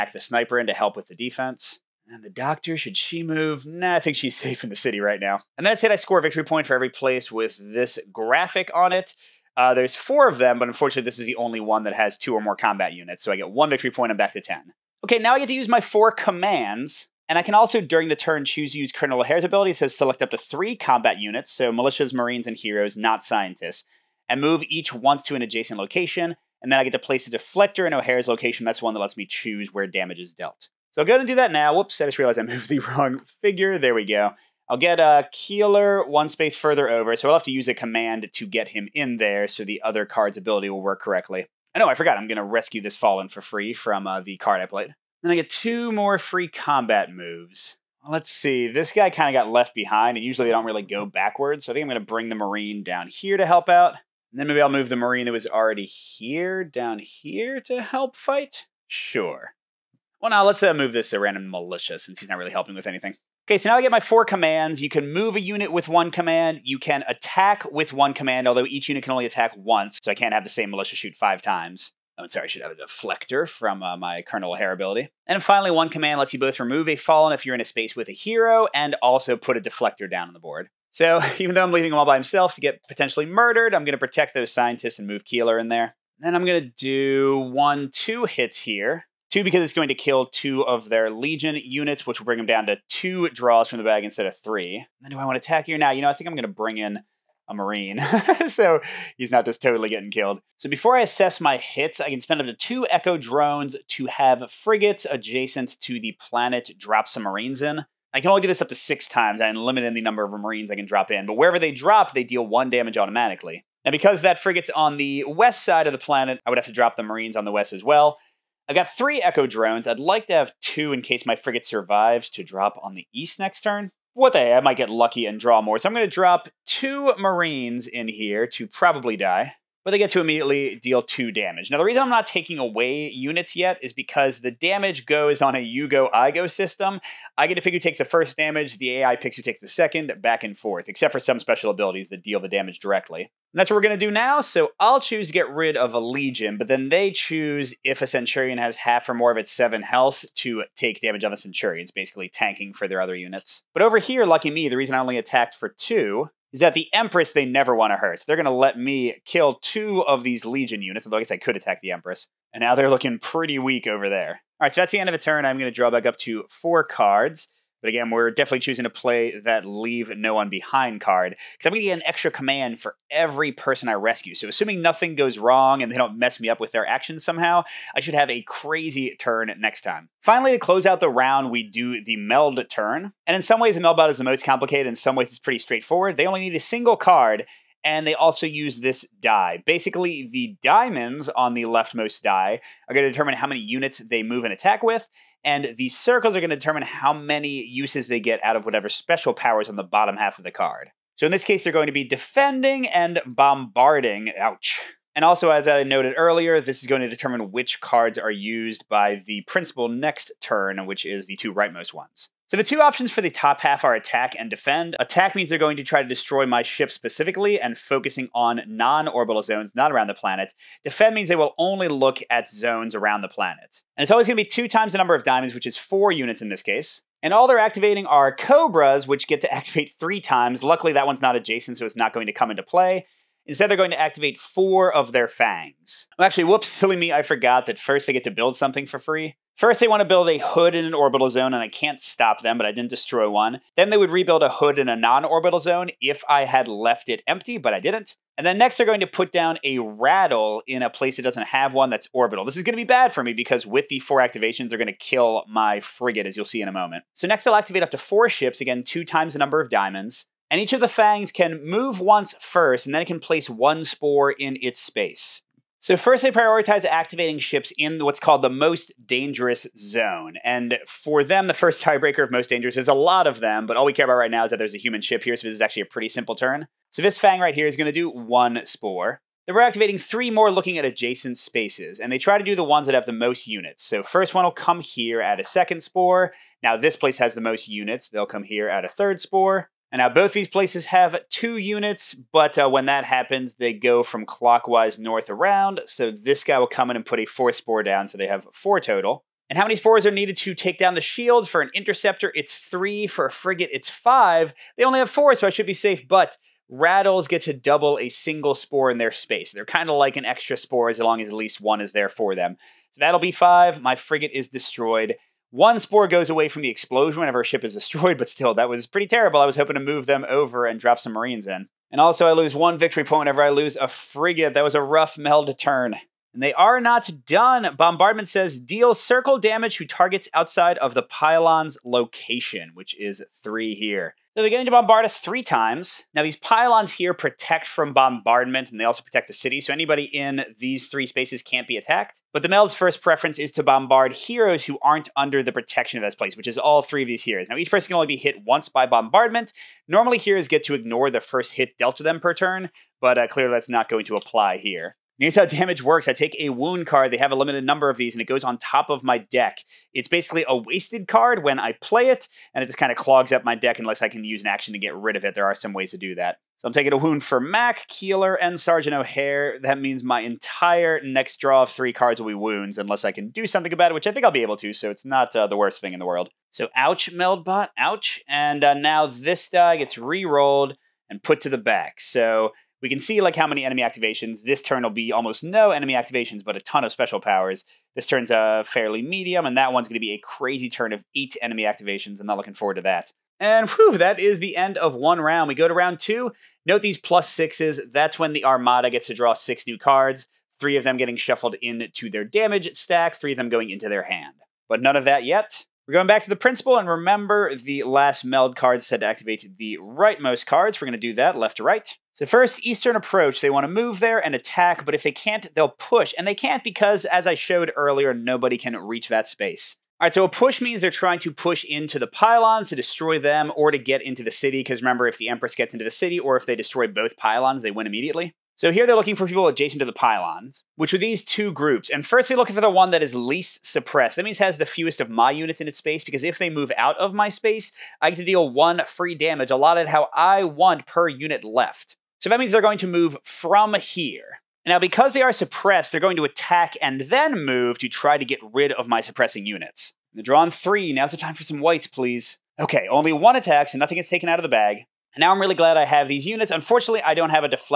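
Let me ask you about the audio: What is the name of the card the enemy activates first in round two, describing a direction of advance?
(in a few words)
Eastern approach.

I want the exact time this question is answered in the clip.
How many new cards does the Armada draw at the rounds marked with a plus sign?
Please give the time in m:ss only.
6:39.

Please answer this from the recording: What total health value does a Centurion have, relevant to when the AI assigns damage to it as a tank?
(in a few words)
7.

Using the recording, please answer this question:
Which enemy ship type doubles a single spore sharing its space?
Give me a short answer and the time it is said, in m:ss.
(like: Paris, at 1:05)
rattles, at 5:06.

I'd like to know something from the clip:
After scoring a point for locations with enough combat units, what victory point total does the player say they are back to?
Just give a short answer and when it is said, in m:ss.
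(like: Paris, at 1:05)
10, at 0:14.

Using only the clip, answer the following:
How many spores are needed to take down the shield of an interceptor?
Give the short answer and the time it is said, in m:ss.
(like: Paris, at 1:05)
3, at 5:01.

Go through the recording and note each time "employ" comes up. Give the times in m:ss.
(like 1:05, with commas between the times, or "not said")
not said.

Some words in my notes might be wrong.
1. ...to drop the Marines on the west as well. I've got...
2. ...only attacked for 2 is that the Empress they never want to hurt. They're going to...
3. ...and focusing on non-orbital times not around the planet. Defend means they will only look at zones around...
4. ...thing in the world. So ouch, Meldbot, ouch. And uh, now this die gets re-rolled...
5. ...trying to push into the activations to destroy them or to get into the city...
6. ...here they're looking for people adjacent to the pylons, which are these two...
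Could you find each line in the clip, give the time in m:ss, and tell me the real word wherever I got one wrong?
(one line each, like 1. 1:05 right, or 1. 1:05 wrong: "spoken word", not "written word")
1. 1:56 right
2. 2:34 right
3. 3:37 wrong: "zones", not "times"
4. 6:15 right
5. 7:00 wrong: "pylons", not "activations"
6. 7:08 right.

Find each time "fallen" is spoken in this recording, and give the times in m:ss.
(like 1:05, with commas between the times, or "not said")
0:42, 1:16.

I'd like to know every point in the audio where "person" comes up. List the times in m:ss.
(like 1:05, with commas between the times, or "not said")
2:53, 5:47.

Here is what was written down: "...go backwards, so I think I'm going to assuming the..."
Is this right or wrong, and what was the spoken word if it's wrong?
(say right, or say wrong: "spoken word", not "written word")
wrong: "bring", not "assuming".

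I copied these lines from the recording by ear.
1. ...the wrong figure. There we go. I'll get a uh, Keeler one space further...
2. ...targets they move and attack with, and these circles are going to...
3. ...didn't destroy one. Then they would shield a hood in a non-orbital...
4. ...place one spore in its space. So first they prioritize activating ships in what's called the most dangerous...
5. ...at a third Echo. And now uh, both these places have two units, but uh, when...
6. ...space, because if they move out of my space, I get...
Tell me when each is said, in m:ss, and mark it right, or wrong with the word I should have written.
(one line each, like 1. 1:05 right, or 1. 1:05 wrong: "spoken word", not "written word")
1. 0:32 right
2. 3:13 wrong: "units", not "targets"
3. 4:02 wrong: "rebuild", not "shield"
4. 4:23 right
5. 4:48 wrong: "Spore", not "Echo"
6. 7:15 right.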